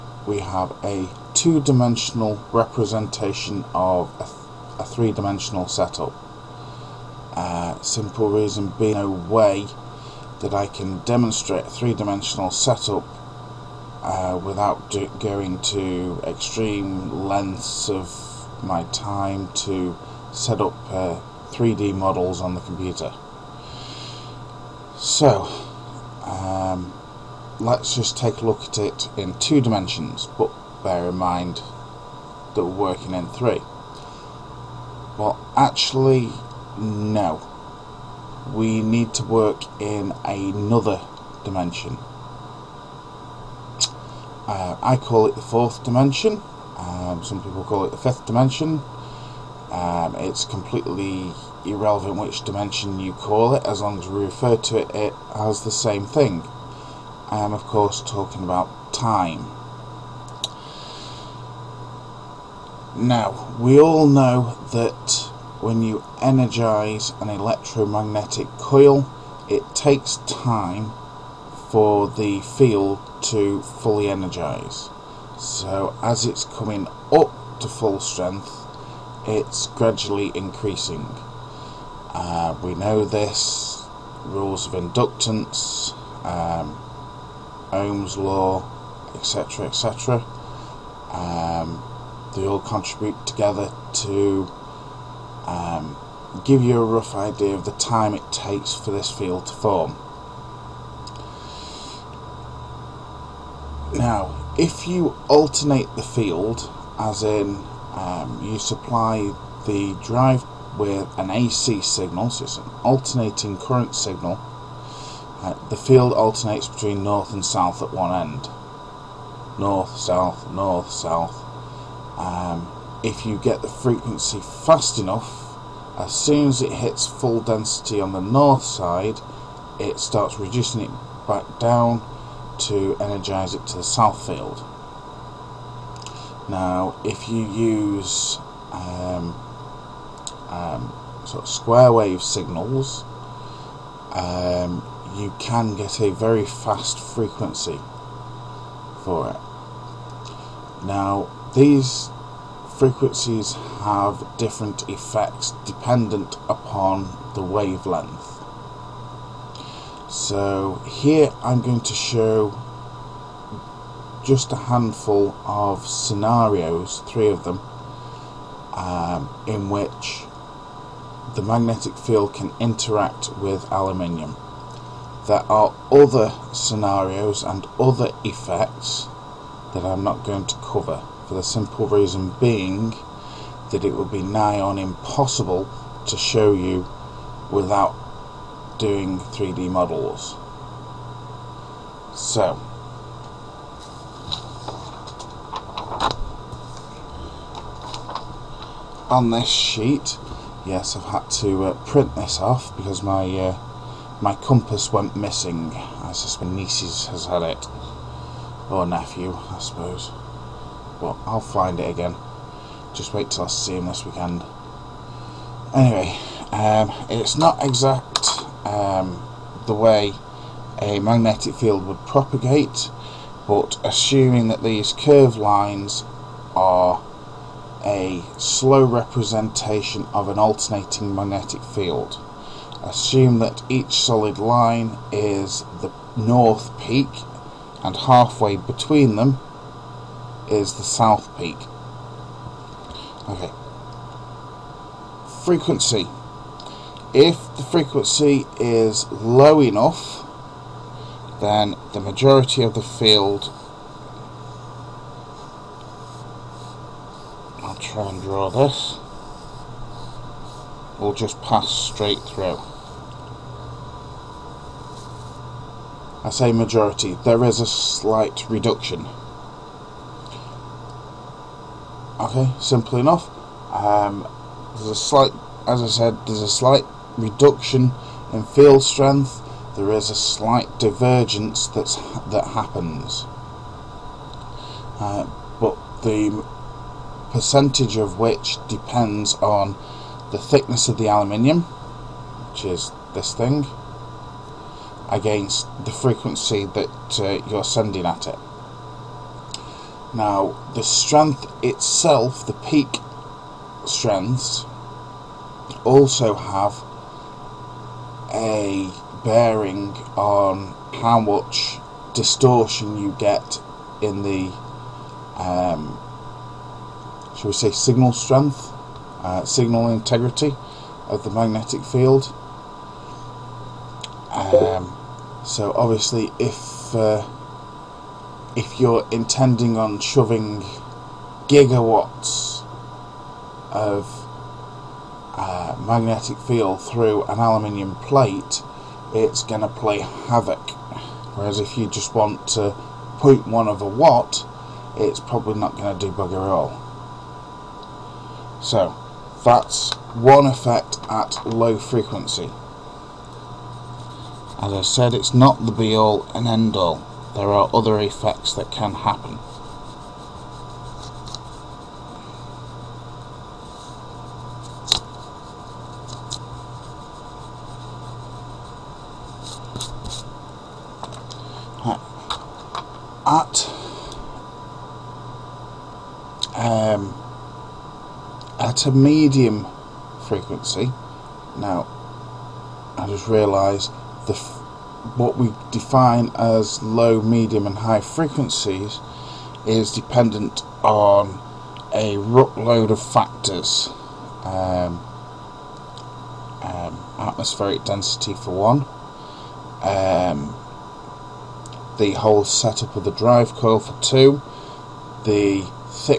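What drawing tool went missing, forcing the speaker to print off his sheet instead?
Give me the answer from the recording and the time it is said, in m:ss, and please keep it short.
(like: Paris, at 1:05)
compass, at 3:24.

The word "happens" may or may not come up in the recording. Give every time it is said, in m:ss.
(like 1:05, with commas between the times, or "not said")
4:42, 5:58.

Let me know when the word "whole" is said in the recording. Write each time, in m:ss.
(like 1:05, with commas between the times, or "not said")
6:42.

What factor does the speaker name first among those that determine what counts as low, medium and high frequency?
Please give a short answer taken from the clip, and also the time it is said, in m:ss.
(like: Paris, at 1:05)
atmospheric density, at 6:37.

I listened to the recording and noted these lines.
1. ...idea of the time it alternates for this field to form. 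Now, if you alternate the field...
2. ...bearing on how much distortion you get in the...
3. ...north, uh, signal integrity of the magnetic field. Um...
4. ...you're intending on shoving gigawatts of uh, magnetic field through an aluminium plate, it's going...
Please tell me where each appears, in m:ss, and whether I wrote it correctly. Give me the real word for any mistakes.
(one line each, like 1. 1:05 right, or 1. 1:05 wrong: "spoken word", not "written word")
1. 1:37 wrong: "takes", not "alternates"
2. 5:09 right
3. 5:18 wrong: "strength", not "north"
4. 5:28 right.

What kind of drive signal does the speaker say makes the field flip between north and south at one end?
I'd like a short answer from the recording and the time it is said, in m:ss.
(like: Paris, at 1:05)
AC signal, at 1:51.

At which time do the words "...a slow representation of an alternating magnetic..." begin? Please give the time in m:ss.
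3:47.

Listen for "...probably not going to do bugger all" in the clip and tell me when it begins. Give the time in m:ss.
5:45.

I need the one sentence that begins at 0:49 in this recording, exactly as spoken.
Um, it's completely irrelevant which dimension you call it, as long as we refer to it, it as the same thing.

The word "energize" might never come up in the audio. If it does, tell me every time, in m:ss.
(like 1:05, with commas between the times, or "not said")
1:06, 1:14, 2:12.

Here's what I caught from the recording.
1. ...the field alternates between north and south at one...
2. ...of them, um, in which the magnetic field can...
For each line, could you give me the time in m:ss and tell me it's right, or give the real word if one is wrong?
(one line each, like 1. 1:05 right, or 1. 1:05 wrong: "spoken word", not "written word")
1. 1:55 right
2. 2:47 right.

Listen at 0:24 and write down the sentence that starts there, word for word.
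So, um, let's just take a look at it in two dimensions, but bear in mind that we're working in three.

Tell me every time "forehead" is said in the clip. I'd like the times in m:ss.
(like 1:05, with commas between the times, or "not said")
not said.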